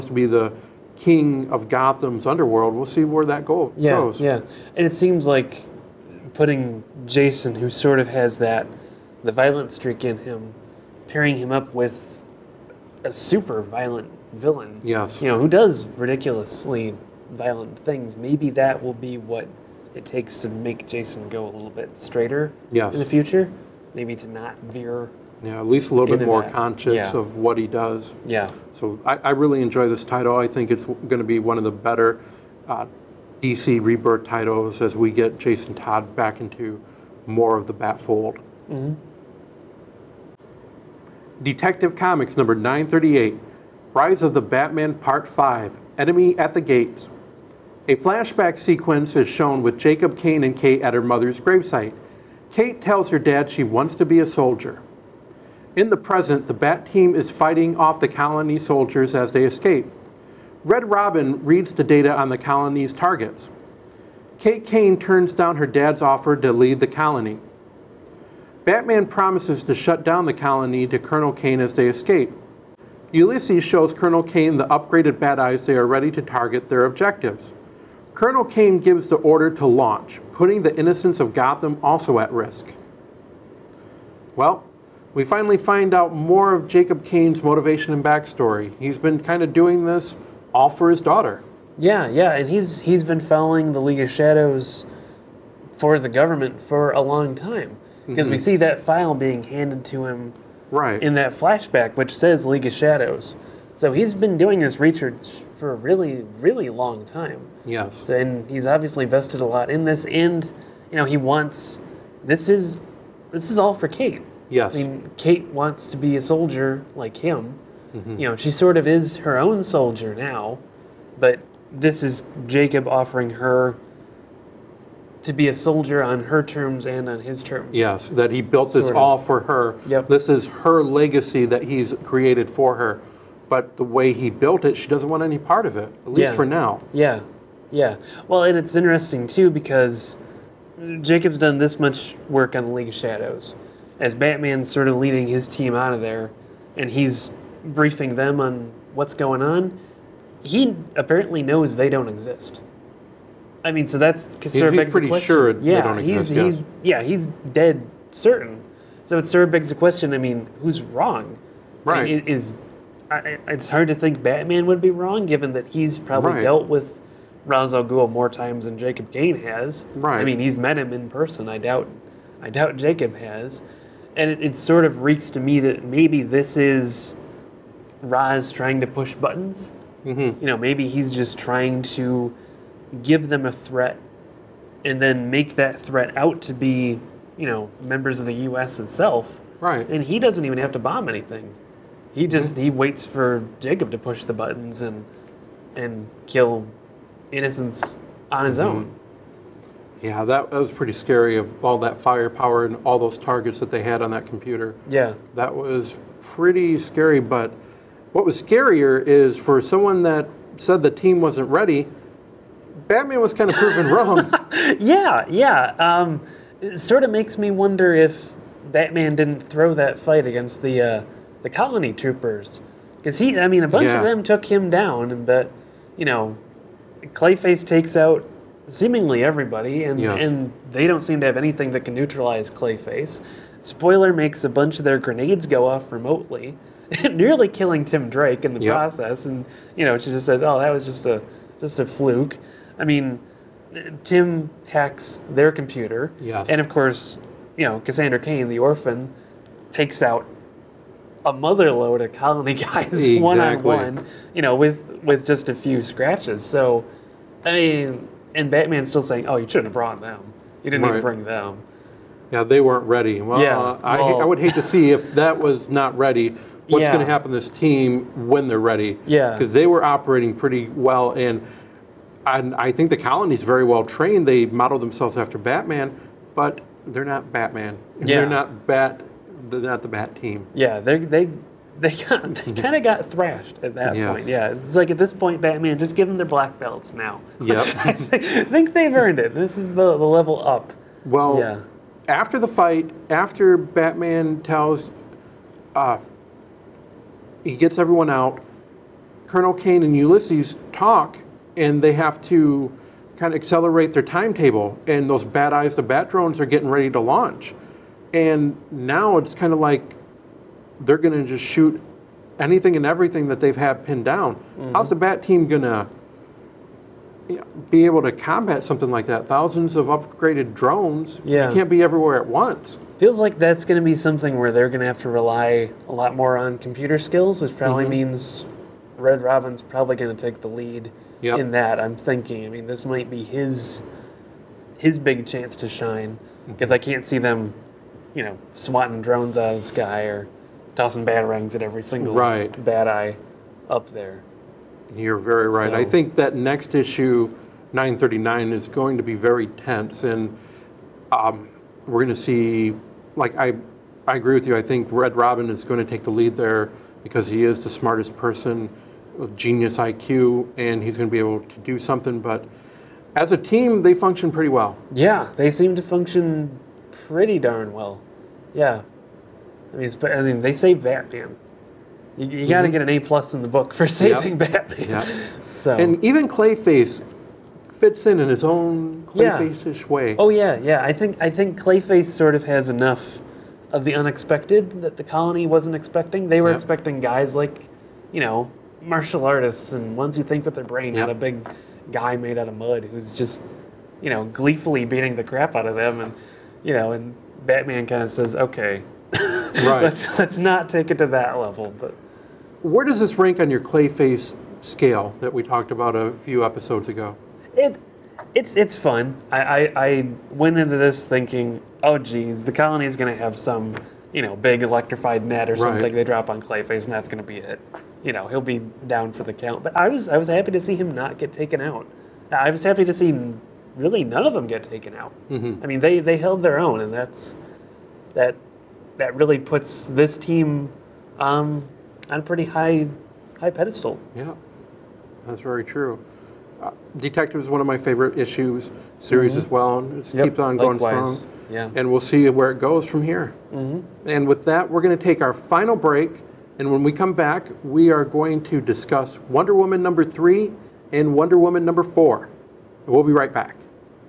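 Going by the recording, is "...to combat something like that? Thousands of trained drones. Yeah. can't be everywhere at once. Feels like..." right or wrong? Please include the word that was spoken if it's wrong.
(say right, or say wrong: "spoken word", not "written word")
wrong: "upgraded", not "trained".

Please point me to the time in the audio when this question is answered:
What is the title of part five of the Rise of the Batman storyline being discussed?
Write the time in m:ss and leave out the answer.
0:45.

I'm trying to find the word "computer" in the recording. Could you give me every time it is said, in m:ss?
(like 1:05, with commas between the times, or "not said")
3:24, 4:05, 5:26.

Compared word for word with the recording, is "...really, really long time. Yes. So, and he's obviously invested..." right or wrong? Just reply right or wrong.
right.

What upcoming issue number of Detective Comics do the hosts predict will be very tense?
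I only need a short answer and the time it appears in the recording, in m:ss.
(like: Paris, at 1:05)
939, at 5:47.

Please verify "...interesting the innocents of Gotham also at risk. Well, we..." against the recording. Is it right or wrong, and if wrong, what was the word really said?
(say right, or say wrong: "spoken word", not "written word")
wrong: "putting", not "interesting".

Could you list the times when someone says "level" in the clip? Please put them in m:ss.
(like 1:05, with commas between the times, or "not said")
4:50, 6:41.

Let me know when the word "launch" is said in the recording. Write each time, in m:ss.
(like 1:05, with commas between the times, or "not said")
1:19, 5:06.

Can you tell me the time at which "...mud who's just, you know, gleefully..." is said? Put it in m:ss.
6:32.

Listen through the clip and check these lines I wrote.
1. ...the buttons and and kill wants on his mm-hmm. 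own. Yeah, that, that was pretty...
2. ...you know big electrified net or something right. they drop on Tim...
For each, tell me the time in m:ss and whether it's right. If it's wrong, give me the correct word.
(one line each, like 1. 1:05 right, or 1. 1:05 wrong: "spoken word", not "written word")
1. 3:14 wrong: "innocents", not "wants"
2. 6:54 wrong: "Clayface", not "Tim".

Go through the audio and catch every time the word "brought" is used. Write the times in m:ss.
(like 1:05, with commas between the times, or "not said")
4:19.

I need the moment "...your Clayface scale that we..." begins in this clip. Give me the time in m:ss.
6:43.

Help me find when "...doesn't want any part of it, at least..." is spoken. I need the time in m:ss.
2:14.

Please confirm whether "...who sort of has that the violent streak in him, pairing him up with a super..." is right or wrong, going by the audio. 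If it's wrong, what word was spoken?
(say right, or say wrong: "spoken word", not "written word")
right.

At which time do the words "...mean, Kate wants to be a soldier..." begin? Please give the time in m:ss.
1:54.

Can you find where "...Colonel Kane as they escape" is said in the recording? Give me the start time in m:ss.
1:10.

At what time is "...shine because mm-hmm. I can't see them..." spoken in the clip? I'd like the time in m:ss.
5:35.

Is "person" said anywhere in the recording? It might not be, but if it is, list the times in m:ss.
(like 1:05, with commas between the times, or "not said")
2:51, 5:58.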